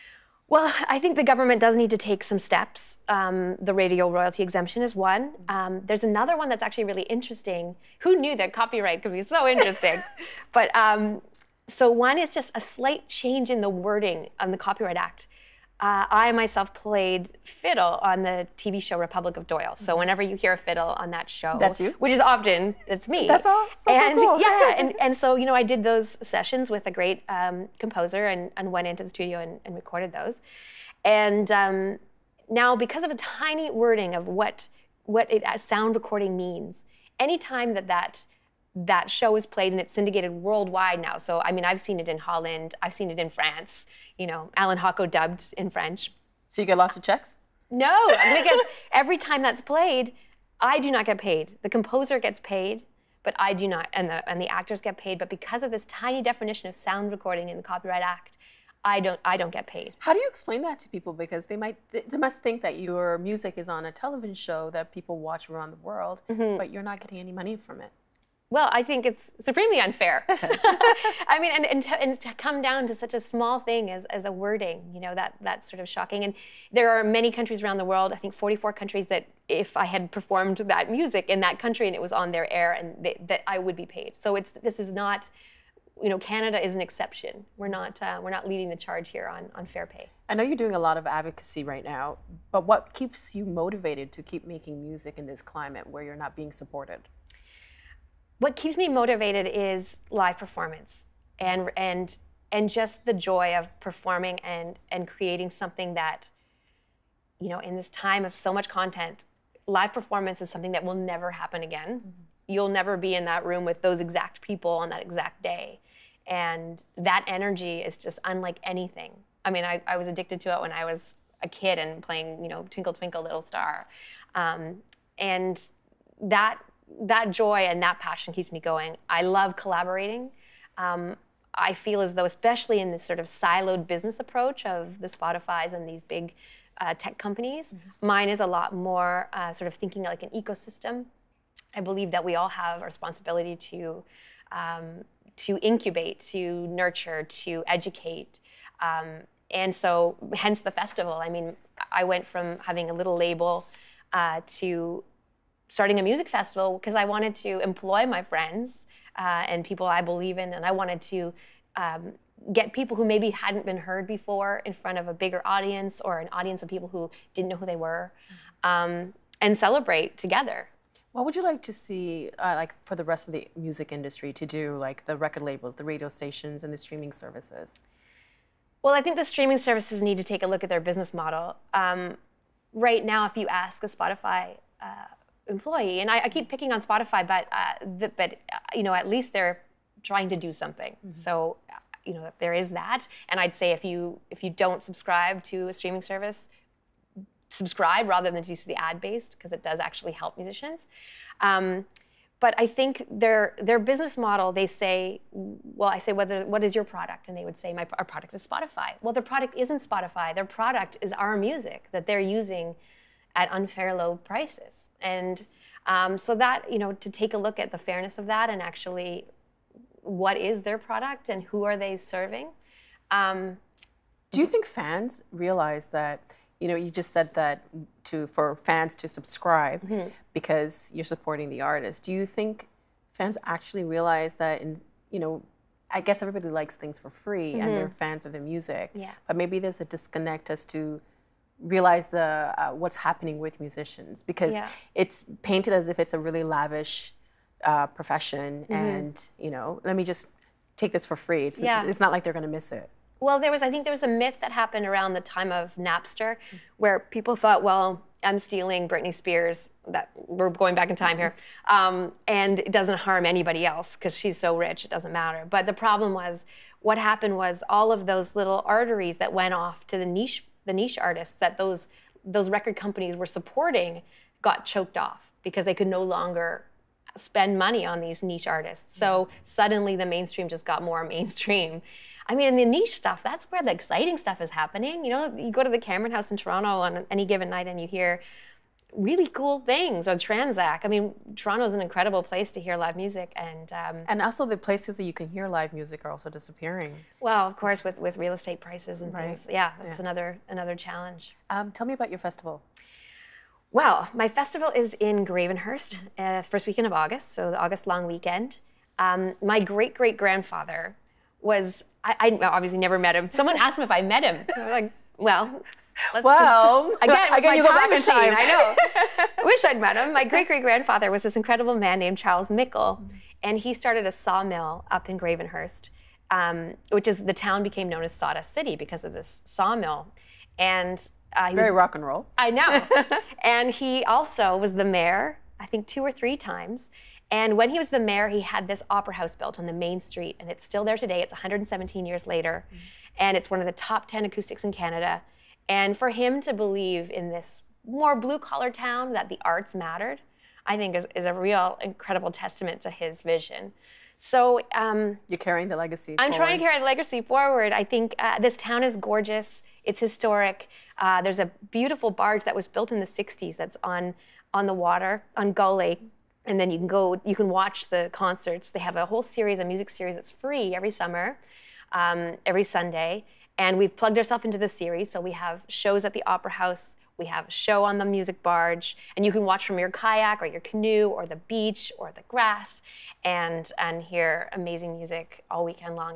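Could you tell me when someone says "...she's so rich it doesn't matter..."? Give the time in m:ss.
4:24.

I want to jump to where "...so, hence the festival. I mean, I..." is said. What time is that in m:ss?
2:29.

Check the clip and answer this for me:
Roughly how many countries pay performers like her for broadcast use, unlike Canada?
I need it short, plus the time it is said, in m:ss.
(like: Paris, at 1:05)
44, at 1:18.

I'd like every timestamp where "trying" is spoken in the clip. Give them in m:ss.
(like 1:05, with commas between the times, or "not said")
3:10, 5:56.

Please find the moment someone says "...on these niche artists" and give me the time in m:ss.
4:37.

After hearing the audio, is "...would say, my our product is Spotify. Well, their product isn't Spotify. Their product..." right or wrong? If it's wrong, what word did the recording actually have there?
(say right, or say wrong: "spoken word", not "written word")
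right.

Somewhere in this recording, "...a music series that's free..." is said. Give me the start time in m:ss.
6:09.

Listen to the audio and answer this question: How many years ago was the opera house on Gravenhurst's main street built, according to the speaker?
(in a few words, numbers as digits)
117.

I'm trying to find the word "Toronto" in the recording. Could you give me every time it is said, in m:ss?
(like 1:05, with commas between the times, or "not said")
4:46, 4:51.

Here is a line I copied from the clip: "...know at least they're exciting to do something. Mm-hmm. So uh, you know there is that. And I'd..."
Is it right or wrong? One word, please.
wrong.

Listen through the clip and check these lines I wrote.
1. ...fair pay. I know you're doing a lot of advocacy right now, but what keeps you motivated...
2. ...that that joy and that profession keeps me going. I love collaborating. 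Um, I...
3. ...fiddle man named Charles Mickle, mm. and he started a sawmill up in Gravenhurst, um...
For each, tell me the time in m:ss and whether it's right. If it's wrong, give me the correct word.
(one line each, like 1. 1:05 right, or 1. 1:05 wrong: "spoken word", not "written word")
1. 1:29 right
2. 2:06 wrong: "passion", not "profession"
3. 5:21 wrong: "incredible", not "fiddle".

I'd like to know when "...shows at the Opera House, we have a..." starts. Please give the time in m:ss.
6:15.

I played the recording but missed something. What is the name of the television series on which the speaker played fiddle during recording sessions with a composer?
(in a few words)
Republic of Doyle.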